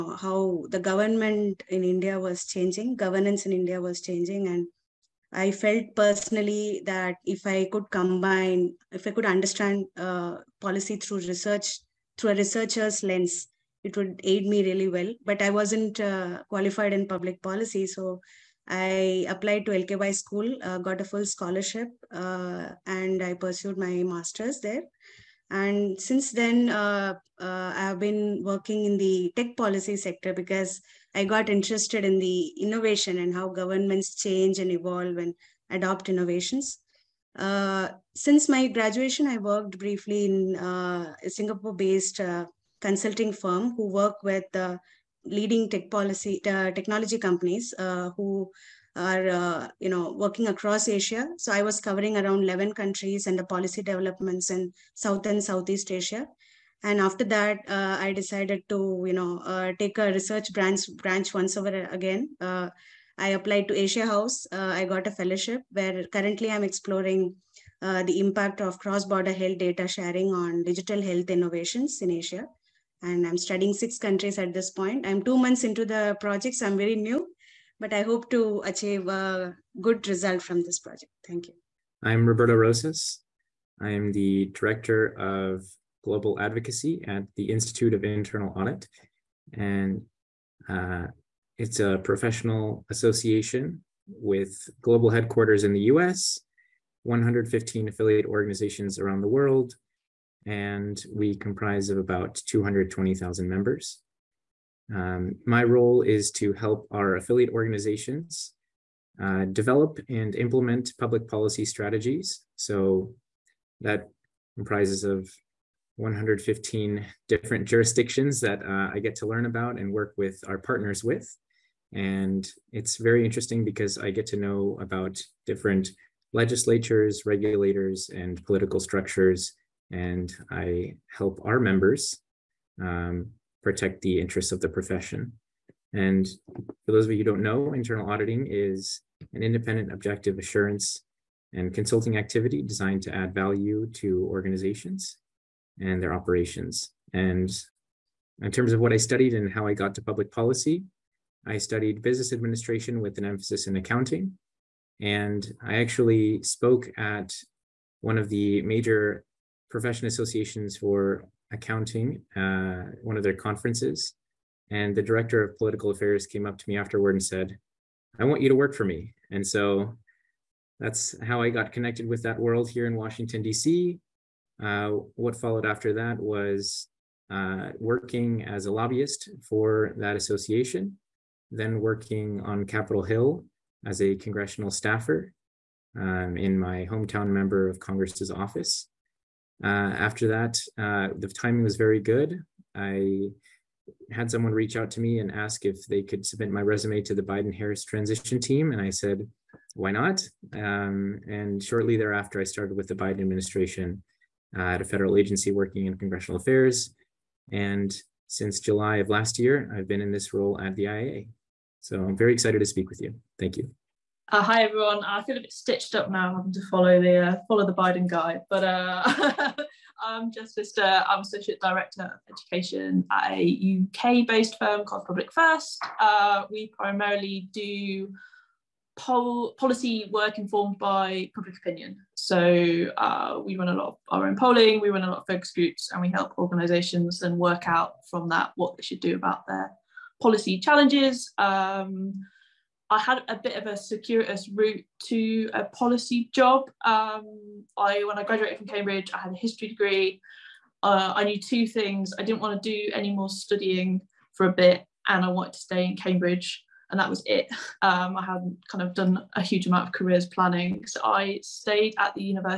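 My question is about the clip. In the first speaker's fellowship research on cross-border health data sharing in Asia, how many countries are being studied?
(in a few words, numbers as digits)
6.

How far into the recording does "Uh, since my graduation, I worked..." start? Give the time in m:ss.
0:37.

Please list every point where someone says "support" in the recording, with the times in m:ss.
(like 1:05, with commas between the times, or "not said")
not said.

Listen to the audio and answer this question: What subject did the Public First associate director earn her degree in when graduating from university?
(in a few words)
History.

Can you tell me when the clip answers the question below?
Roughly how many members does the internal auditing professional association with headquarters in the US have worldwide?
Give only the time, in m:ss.
1:42.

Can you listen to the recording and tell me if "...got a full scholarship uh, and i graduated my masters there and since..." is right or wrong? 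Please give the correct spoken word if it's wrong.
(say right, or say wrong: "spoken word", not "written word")
wrong: "pursued", not "graduated".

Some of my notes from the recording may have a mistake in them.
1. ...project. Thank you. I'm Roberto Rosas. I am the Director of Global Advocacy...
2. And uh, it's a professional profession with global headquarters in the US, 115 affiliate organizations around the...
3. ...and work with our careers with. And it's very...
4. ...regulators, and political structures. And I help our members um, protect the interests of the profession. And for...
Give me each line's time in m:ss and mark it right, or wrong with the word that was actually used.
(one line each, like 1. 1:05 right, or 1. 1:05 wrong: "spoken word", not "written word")
1. 1:20 right
2. 1:29 wrong: "association", not "profession"
3. 1:59 wrong: "partners", not "careers"
4. 2:07 right.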